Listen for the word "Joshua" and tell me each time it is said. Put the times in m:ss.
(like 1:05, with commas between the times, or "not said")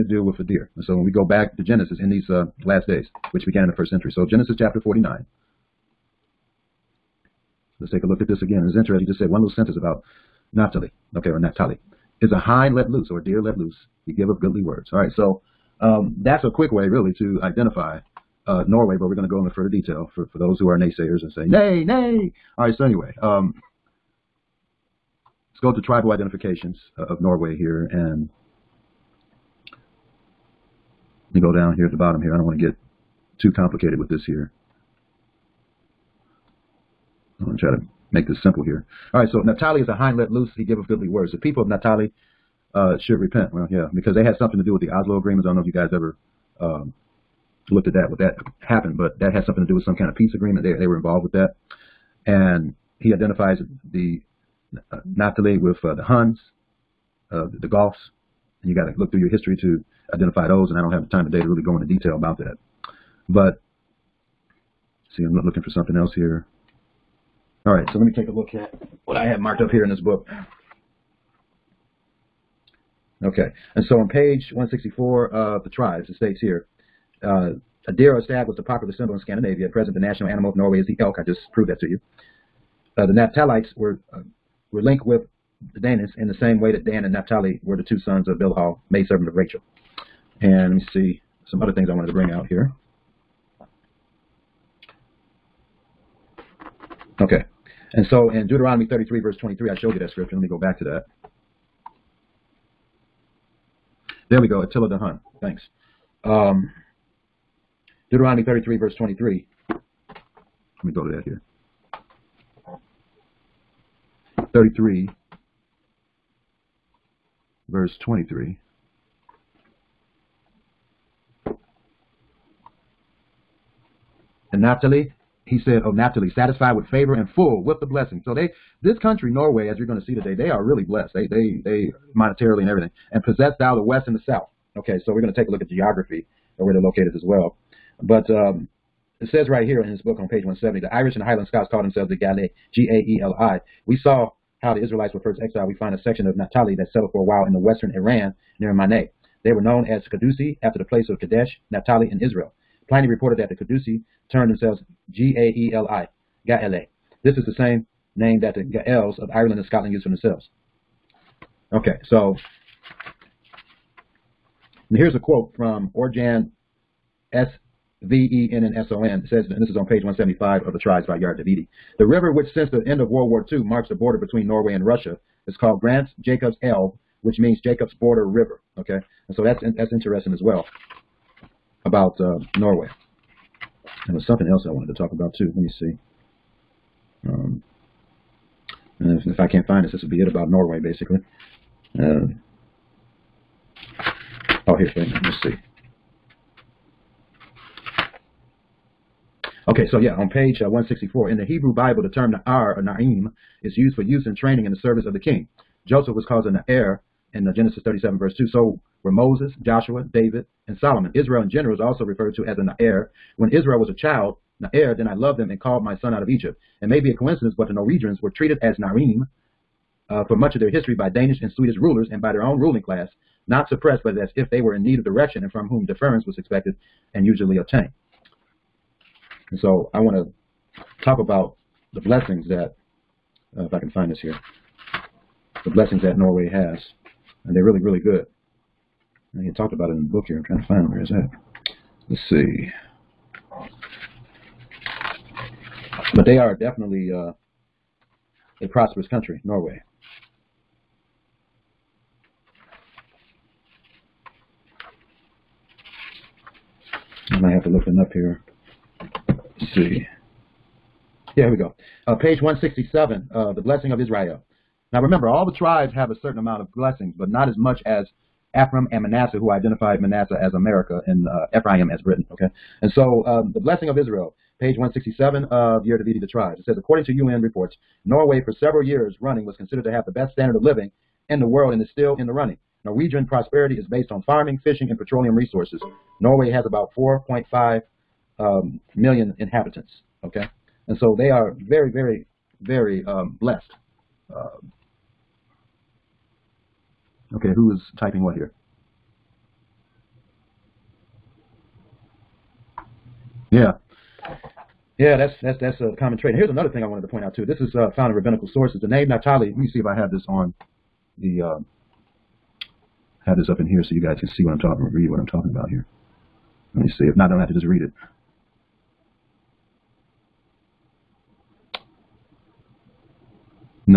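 3:29.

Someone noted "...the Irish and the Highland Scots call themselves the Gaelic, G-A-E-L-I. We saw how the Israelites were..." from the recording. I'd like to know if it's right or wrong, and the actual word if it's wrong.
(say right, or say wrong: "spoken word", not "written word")
right.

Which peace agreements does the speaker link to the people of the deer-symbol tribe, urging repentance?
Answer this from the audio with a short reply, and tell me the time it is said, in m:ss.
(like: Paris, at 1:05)
Oslo agreements, at 0:44.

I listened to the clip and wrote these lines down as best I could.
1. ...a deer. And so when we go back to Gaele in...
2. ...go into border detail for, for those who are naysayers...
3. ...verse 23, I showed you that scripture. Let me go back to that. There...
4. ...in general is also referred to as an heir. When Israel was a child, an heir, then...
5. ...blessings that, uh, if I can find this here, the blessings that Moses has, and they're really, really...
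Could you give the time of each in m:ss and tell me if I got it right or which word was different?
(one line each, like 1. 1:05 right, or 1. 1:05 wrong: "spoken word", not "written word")
1. 0:00 wrong: "Genesis", not "Gaele"
2. 0:19 wrong: "further", not "border"
3. 1:39 right
4. 3:31 right
5. 3:51 wrong: "Norway", not "Moses".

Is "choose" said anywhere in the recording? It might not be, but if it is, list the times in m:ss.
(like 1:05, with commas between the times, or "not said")
not said.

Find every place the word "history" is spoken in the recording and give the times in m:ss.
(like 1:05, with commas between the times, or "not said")
0:59, 3:40.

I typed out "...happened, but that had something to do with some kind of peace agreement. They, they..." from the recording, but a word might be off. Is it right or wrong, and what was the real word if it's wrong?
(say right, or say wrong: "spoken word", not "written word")
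right.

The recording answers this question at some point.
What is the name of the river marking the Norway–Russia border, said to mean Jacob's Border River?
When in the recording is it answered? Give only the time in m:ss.
2:55.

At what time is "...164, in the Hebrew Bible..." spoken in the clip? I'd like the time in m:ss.
3:20.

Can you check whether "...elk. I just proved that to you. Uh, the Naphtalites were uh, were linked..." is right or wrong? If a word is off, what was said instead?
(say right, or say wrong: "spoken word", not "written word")
right.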